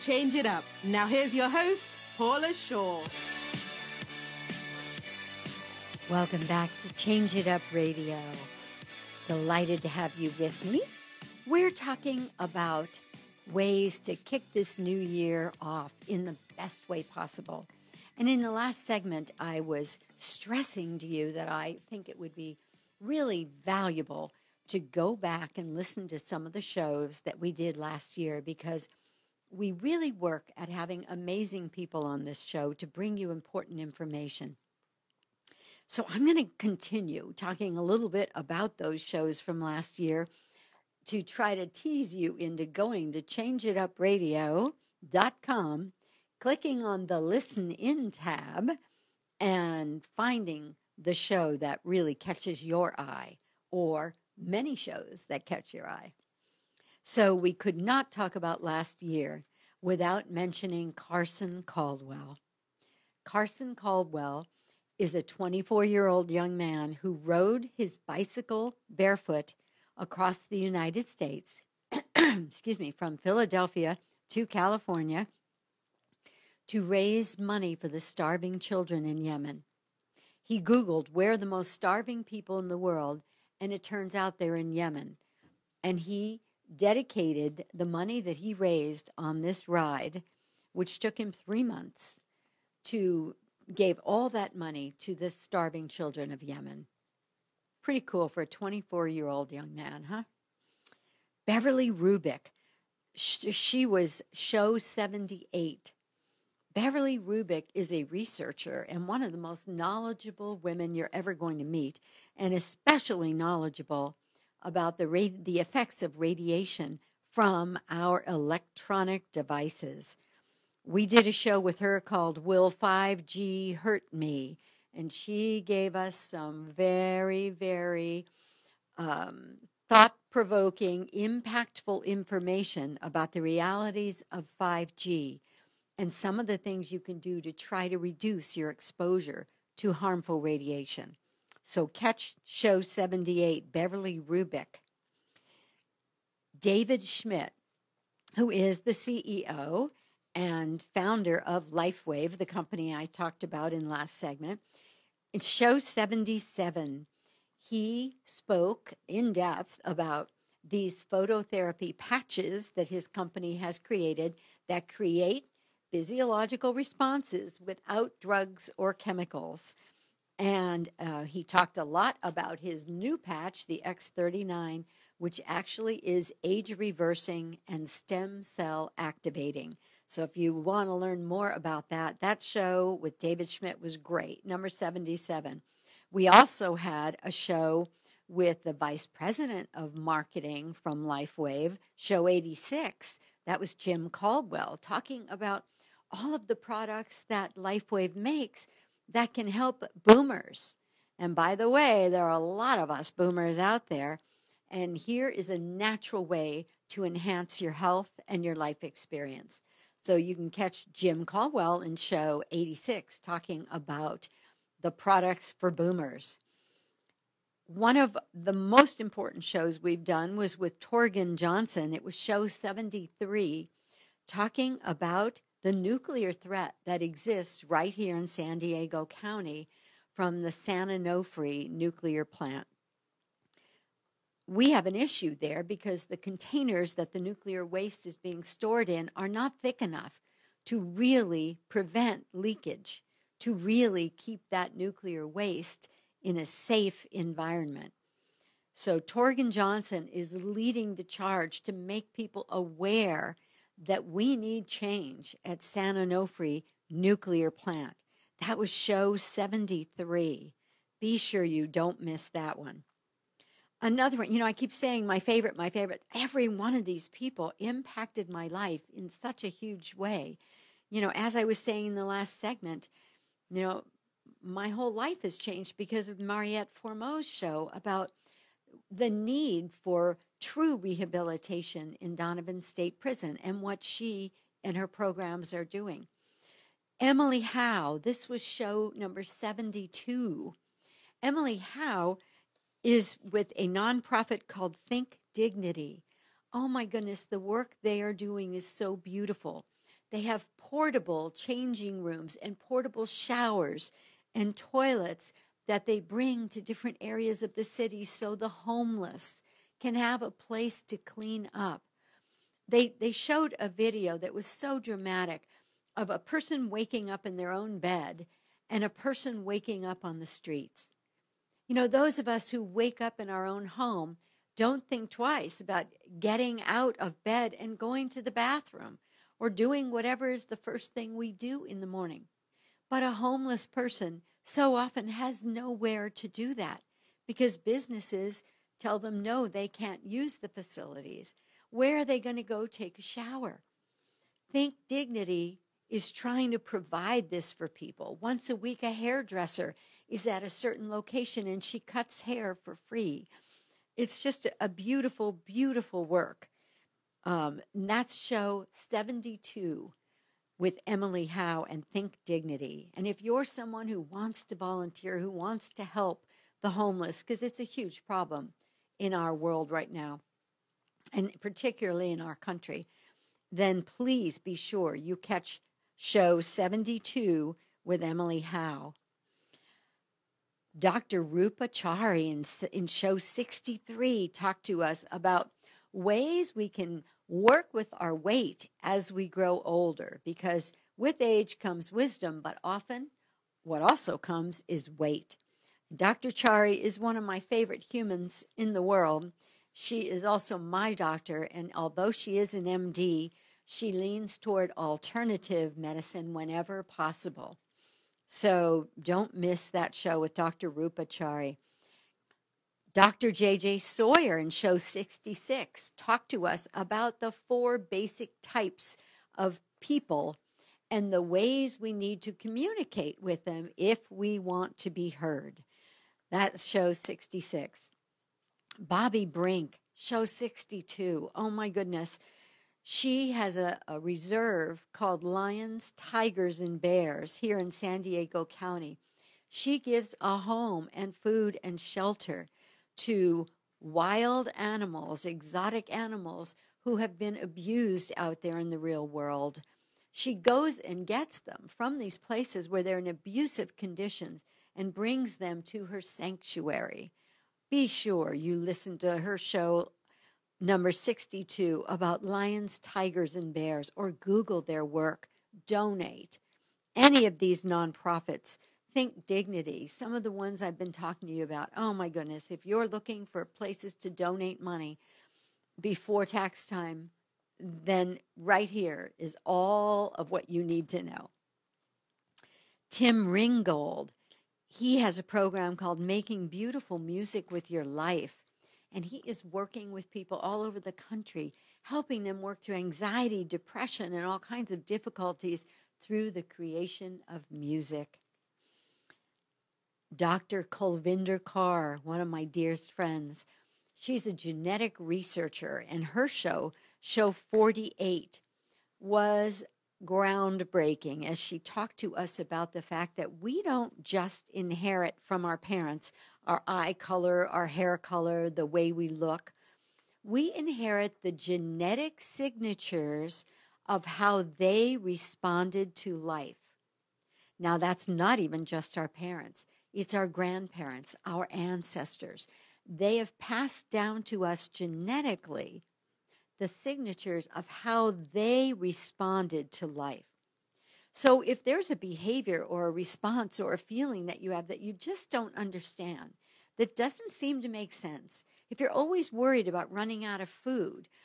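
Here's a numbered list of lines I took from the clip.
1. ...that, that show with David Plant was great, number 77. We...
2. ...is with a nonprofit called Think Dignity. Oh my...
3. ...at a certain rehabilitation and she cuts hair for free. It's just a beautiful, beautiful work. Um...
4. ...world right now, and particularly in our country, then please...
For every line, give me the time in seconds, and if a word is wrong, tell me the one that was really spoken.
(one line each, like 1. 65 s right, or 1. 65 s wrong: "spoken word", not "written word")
1. 181 s wrong: "Schmidt", not "Plant"
2. 292 s right
3. 350 s wrong: "location", not "rehabilitation"
4. 369 s right.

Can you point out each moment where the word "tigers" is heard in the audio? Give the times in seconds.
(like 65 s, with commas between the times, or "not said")
435 s, 462 s.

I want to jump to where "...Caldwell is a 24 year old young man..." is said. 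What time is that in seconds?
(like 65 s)
63 s.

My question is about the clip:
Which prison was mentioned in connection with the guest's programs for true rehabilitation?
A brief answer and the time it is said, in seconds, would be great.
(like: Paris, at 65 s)
Donovan State Prison, at 282 s.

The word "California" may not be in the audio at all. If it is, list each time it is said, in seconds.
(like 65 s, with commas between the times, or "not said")
74 s.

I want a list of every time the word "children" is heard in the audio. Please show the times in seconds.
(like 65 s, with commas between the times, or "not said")
78 s, 95 s.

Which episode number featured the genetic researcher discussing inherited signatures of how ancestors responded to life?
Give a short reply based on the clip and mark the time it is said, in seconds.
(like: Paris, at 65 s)
48, at 506 s.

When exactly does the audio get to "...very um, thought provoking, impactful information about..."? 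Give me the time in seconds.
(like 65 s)
127 s.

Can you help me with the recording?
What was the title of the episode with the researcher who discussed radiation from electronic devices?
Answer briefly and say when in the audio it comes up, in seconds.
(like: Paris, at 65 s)
Will 5G Hurt Me?, at 122 s.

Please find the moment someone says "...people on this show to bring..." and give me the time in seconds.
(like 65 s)
31 s.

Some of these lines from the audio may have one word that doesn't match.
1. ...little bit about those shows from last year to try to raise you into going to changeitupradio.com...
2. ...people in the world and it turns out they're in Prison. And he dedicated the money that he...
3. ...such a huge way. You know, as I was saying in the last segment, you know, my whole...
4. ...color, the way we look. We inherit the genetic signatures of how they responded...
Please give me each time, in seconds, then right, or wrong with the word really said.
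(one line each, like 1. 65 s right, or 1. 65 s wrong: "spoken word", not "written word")
1. 37 s wrong: "tease", not "raise"
2. 82 s wrong: "Yemen", not "Prison"
3. 269 s right
4. 517 s right.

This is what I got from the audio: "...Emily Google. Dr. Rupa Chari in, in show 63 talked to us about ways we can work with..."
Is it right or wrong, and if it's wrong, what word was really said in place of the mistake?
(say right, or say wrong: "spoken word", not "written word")
wrong: "Howe", not "Google".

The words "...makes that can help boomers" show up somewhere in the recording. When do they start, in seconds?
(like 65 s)
198 s.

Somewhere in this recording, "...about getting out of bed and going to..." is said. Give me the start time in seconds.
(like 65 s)
325 s.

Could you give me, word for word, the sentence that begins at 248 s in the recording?
So, Torgen Johnson is leading the charge to make people aware that we need change at San Onofre Nuclear Plant.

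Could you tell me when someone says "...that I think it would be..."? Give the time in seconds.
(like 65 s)
21 s.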